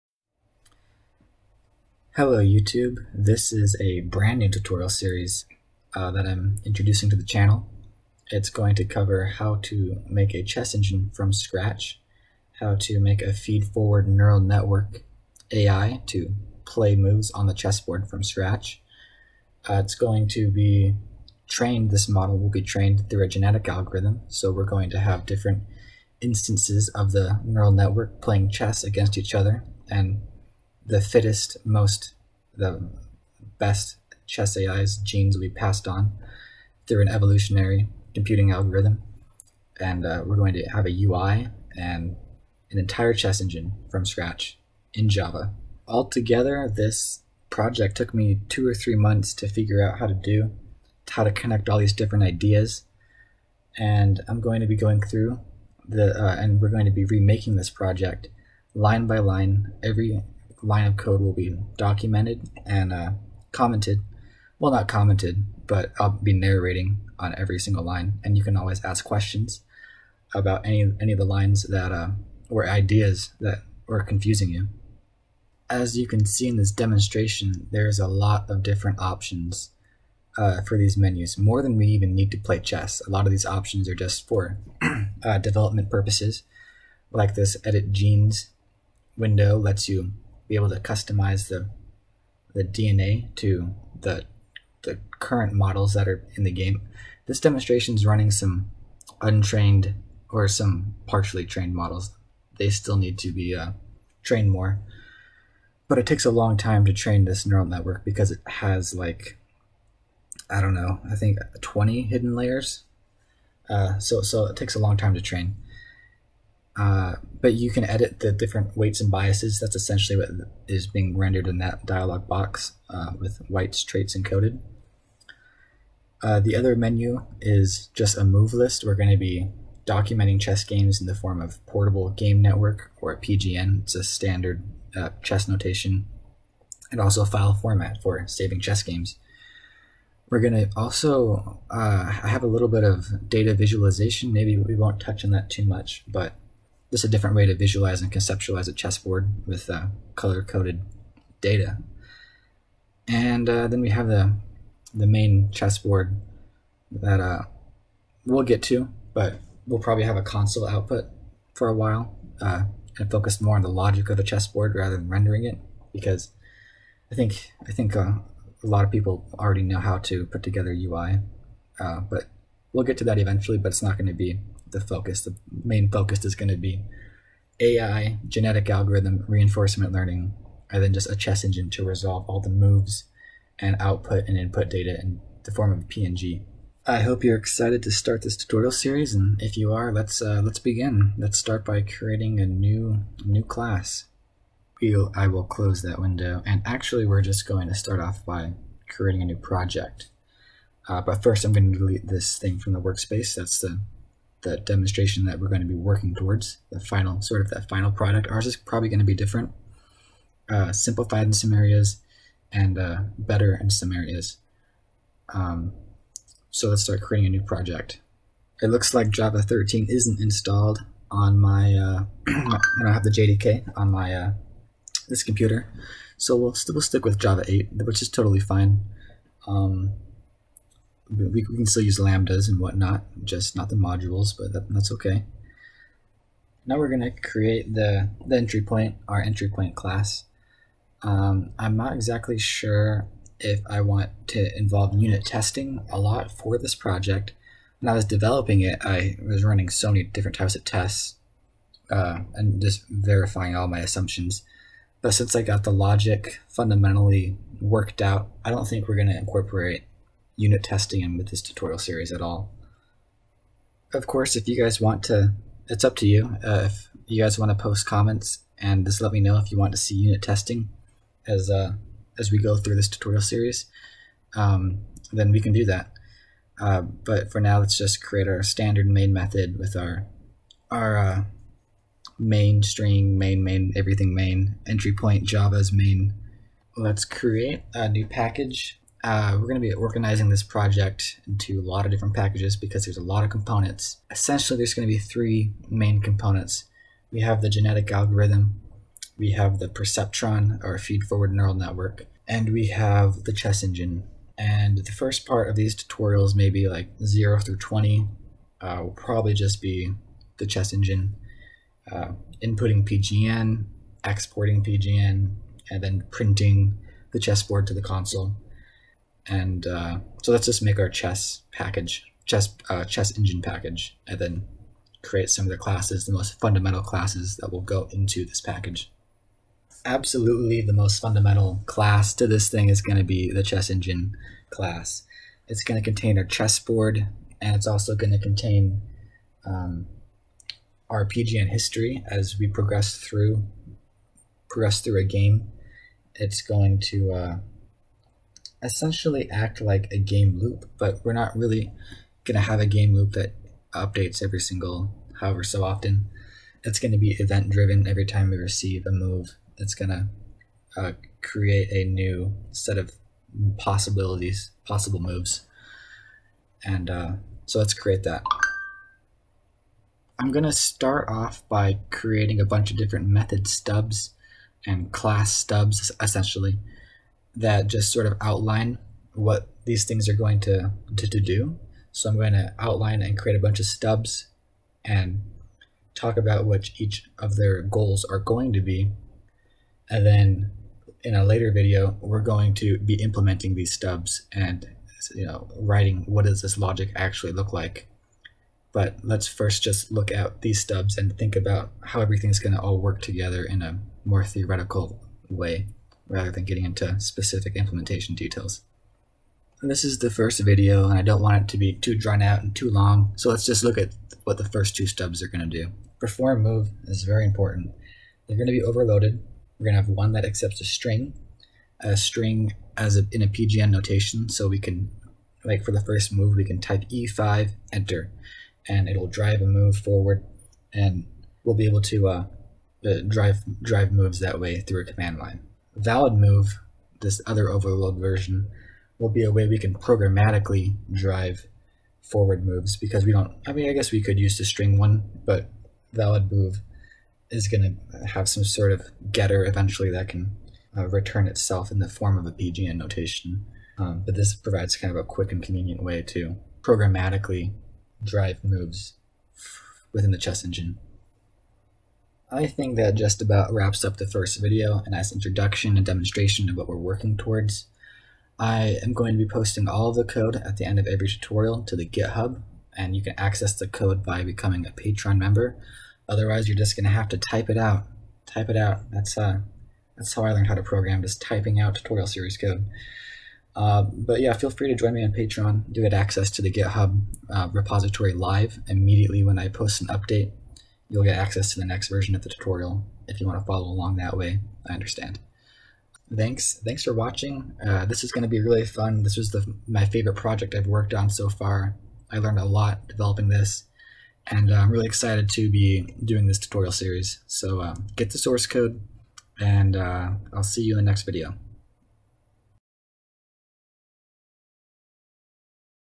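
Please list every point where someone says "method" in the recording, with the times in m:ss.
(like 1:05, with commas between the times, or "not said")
4:39, 6:13.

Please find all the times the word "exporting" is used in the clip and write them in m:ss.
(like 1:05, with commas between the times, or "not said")
5:14.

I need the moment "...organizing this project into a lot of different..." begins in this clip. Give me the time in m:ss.
4:49.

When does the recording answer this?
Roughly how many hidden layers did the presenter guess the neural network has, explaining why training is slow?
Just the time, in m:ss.
1:51.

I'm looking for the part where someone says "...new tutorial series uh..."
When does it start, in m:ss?
0:04.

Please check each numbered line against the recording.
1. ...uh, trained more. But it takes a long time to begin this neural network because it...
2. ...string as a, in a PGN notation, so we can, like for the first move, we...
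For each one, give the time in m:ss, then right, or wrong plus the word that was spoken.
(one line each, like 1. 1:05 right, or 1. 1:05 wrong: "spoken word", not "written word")
1. 1:43 wrong: "train", not "begin"
2. 7:01 right.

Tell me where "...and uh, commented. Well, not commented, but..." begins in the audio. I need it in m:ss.
1:02.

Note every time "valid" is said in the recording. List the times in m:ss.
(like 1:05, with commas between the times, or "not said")
7:15, 7:25.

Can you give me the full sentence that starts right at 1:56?
Uh, but you can edit the different weights and biases.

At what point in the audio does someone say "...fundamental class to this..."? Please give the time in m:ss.
5:31.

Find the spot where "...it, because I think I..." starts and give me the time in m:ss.
2:45.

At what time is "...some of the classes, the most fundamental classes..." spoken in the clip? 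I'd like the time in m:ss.
5:25.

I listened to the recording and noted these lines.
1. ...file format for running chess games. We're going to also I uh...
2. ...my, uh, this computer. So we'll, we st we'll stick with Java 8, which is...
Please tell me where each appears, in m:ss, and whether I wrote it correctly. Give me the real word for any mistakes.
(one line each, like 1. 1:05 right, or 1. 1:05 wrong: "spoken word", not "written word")
1. 2:17 wrong: "saving", not "running"
2. 3:43 right.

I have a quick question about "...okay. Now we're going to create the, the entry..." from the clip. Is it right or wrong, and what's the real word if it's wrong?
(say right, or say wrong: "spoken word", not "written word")
right.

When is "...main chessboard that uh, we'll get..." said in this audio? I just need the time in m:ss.
2:35.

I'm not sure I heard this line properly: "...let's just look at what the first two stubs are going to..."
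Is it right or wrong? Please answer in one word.
right.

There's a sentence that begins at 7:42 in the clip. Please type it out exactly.
I think that just about wraps up the first video, a nice introduction and demonstration of what we're working towards.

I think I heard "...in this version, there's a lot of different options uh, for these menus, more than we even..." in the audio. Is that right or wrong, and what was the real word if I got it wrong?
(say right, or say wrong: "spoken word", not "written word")
wrong: "demonstration", not "version".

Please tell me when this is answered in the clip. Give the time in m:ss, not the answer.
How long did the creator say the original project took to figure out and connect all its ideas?
0:48.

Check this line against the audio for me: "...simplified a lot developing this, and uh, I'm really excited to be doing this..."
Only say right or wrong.
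wrong.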